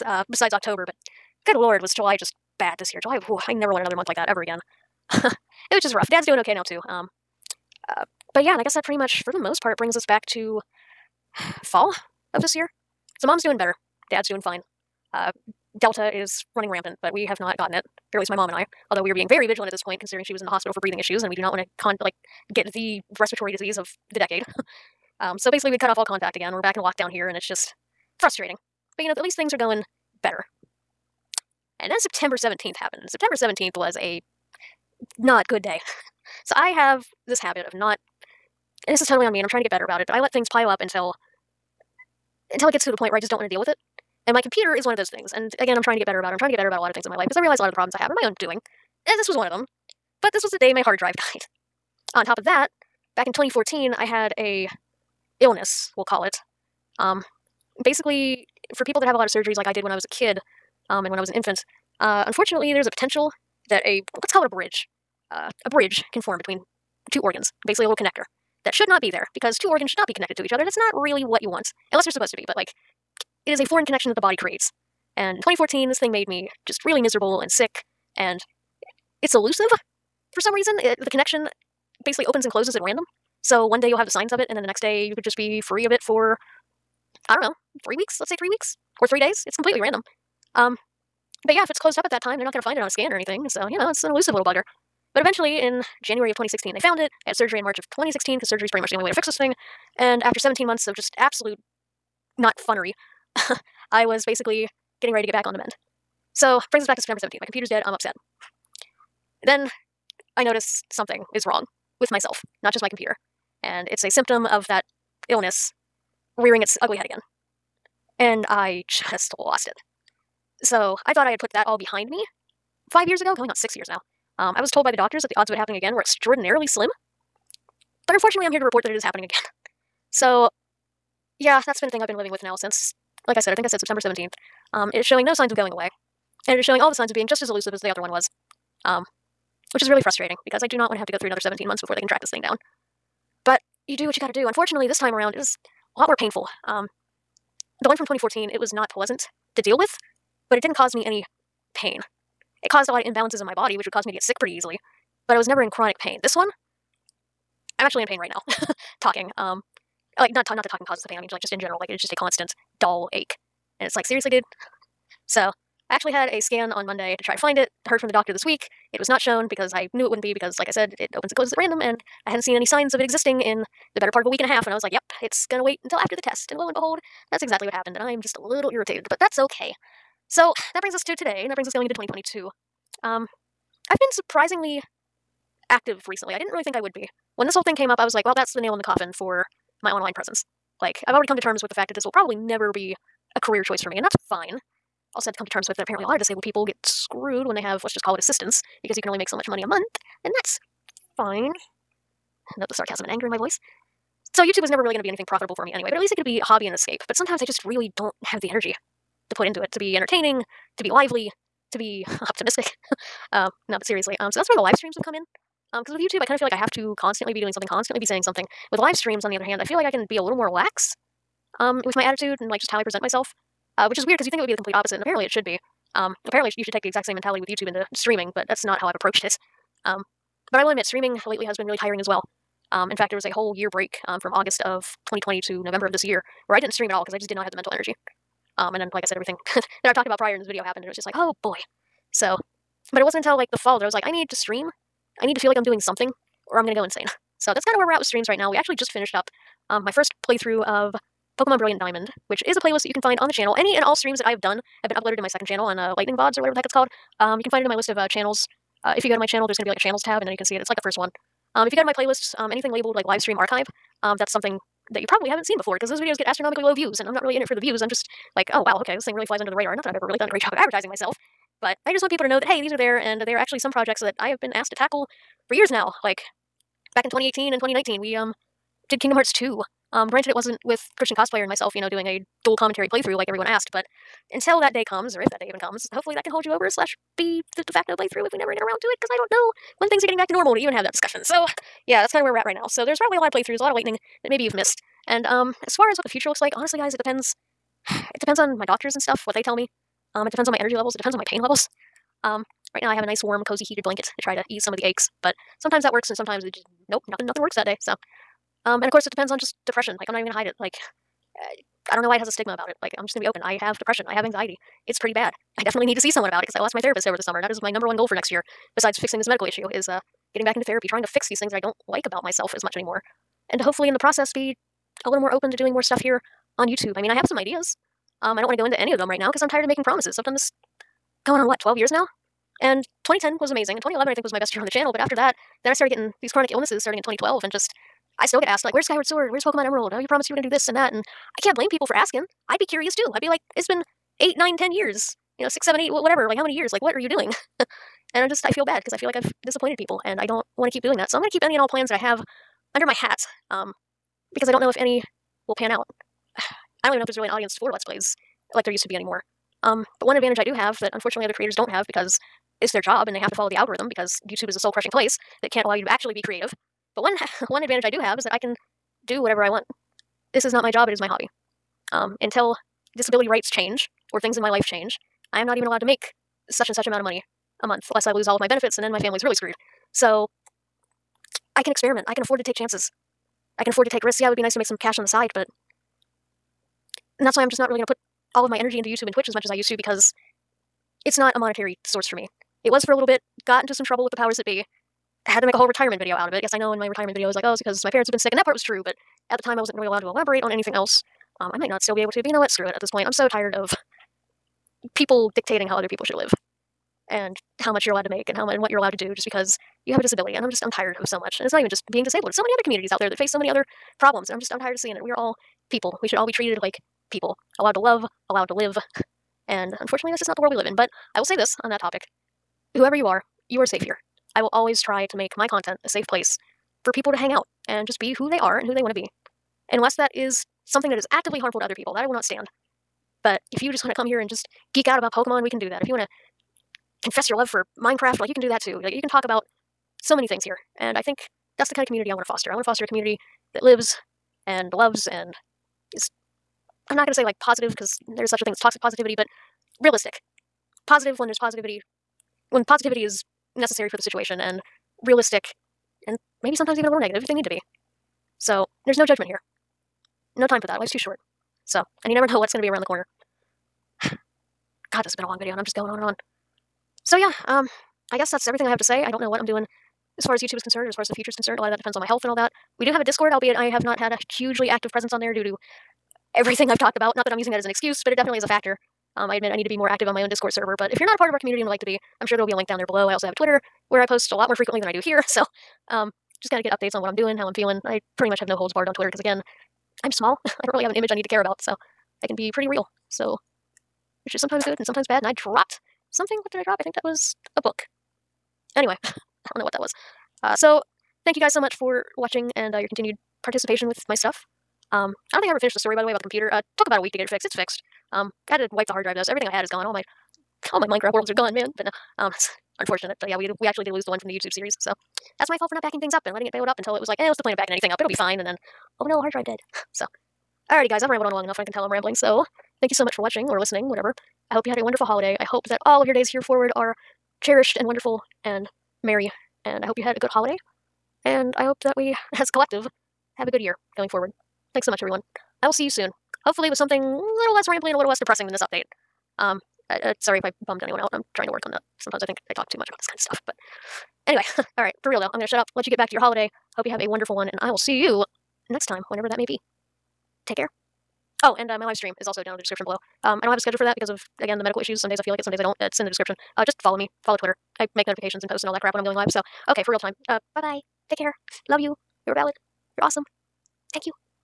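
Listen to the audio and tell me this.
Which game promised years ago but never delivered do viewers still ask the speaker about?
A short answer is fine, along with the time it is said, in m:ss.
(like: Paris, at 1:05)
Skyward Sword, at 5:38.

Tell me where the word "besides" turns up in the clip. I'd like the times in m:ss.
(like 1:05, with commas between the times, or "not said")
0:00, 5:18.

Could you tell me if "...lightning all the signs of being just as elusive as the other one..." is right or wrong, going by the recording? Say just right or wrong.
wrong.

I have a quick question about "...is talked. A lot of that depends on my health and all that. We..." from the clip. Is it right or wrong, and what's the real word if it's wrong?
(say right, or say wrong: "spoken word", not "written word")
wrong: "concerned", not "talked".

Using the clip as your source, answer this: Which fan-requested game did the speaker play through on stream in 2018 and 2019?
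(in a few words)
Kingdom Hearts 2.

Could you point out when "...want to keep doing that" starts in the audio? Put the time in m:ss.
5:50.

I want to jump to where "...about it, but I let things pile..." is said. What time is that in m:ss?
0:39.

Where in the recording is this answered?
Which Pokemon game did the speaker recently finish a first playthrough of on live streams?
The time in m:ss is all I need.
4:11.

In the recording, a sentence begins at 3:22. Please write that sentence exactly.
Note the sarcasm and anger in my voice.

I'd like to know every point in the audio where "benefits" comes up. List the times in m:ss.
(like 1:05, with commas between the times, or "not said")
6:18.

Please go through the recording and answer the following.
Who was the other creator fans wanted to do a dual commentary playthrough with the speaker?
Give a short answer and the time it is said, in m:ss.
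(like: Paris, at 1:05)
Christian Cosplayer, at 4:40.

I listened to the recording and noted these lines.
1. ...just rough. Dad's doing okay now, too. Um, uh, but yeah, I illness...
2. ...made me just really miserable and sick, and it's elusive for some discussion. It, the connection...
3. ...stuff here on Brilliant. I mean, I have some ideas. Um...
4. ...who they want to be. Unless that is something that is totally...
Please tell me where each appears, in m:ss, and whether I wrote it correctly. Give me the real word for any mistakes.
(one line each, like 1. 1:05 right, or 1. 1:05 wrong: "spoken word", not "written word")
1. 0:05 wrong: "guess", not "illness"
2. 1:16 wrong: "reason", not "discussion"
3. 5:25 wrong: "YouTube", not "Brilliant"
4. 7:08 wrong: "actively", not "totally".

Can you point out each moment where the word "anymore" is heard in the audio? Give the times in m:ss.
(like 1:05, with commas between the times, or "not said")
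5:22, 5:58.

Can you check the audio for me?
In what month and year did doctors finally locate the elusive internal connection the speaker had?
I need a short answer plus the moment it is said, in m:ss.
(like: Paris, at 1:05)
January 2016, at 1:36.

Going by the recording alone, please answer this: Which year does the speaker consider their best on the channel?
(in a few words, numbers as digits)
2011.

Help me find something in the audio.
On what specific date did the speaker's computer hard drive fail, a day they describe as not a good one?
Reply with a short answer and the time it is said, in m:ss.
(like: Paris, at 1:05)
September 17th, at 0:31.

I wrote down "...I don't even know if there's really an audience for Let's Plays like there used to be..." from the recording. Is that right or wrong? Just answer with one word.
right.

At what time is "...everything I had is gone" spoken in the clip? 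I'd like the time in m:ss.
8:29.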